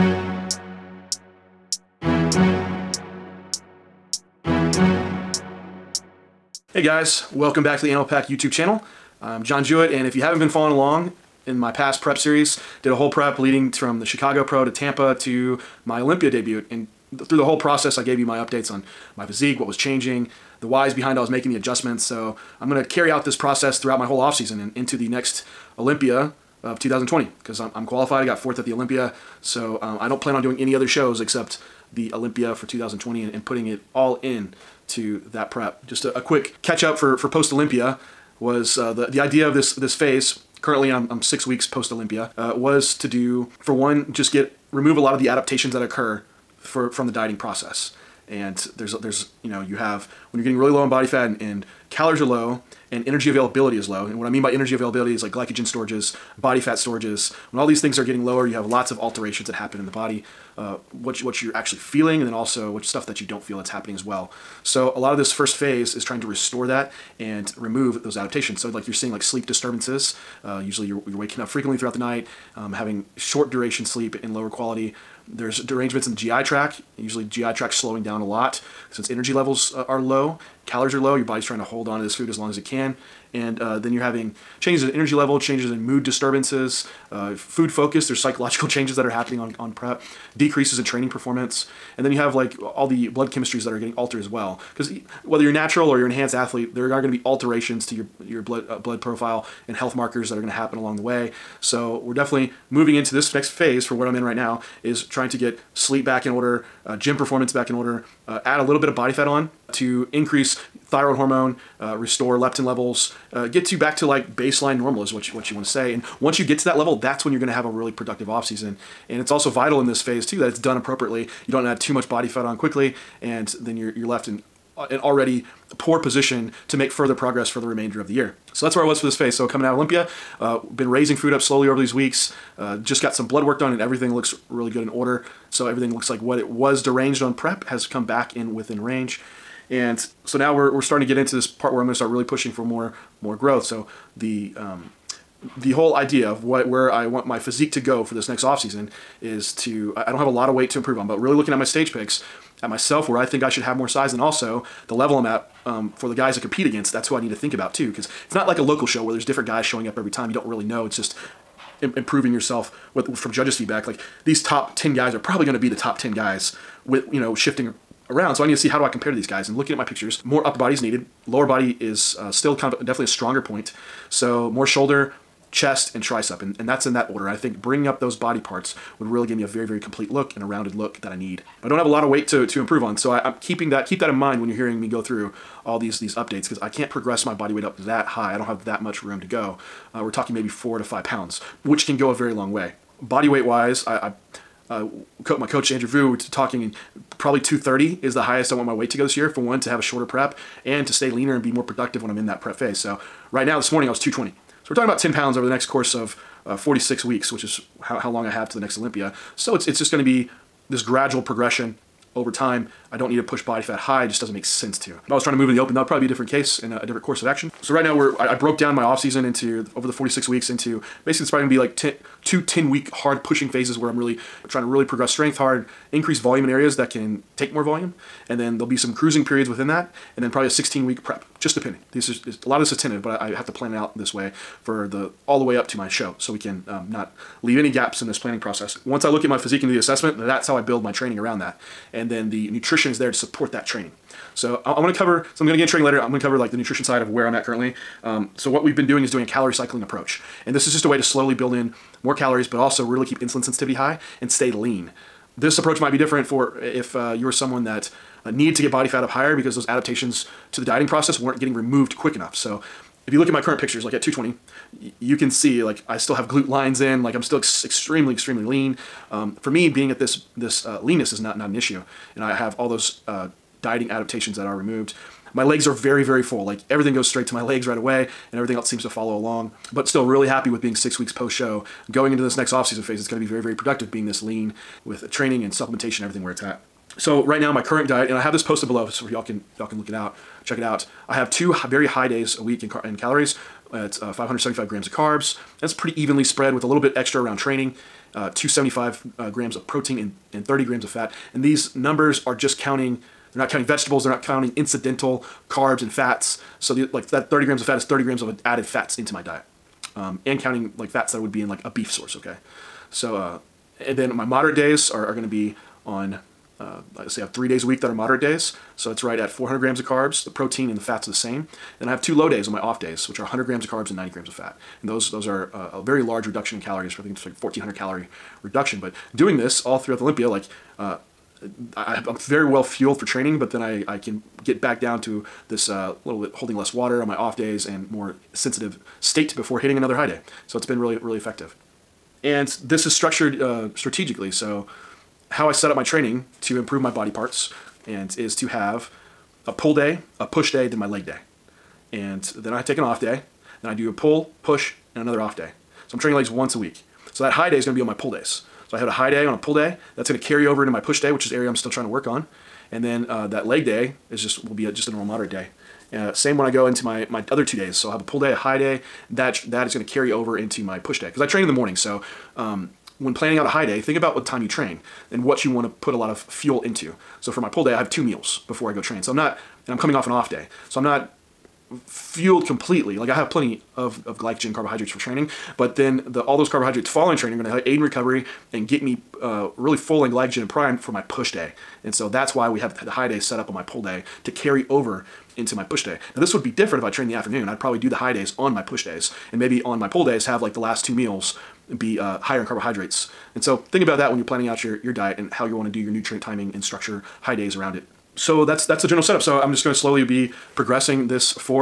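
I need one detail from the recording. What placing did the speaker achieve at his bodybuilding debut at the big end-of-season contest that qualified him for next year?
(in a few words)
4th.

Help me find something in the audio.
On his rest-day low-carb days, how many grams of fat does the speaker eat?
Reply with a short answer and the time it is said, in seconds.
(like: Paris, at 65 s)
90 grams, at 323 s.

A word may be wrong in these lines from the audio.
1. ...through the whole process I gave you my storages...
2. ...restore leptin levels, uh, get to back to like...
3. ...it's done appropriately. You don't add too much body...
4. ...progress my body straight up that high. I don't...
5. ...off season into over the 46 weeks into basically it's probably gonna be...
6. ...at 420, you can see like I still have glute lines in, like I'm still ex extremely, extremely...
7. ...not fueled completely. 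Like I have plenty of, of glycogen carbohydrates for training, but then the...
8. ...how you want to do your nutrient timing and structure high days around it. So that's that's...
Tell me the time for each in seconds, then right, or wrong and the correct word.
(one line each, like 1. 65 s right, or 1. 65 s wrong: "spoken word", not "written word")
1. 17 s wrong: "updates", not "storages"
2. 111 s right
3. 120 s right
4. 186 s wrong: "weight", not "straight"
5. 218 s right
6. 263 s wrong: "220", not "420"
7. 380 s right
8. 405 s right.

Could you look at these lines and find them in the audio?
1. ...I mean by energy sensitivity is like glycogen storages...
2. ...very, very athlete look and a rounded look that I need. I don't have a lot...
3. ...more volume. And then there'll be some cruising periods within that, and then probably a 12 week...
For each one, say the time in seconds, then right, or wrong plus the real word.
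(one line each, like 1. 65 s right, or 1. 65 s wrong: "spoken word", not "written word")
1. 54 s wrong: "availability", not "sensitivity"
2. 179 s wrong: "complete", not "athlete"
3. 227 s wrong: "16", not "12".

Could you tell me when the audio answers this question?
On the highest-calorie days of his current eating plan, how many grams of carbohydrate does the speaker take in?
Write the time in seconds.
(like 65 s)
294 s.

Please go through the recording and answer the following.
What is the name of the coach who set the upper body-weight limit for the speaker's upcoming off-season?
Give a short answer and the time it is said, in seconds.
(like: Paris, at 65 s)
Andrew Vu, at 195 s.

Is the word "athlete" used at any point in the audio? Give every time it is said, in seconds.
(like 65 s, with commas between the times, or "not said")
96 s.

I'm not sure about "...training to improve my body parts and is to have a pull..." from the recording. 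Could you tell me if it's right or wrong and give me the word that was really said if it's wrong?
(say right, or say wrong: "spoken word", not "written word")
right.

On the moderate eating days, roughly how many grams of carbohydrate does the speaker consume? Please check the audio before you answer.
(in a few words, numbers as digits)
400 grams.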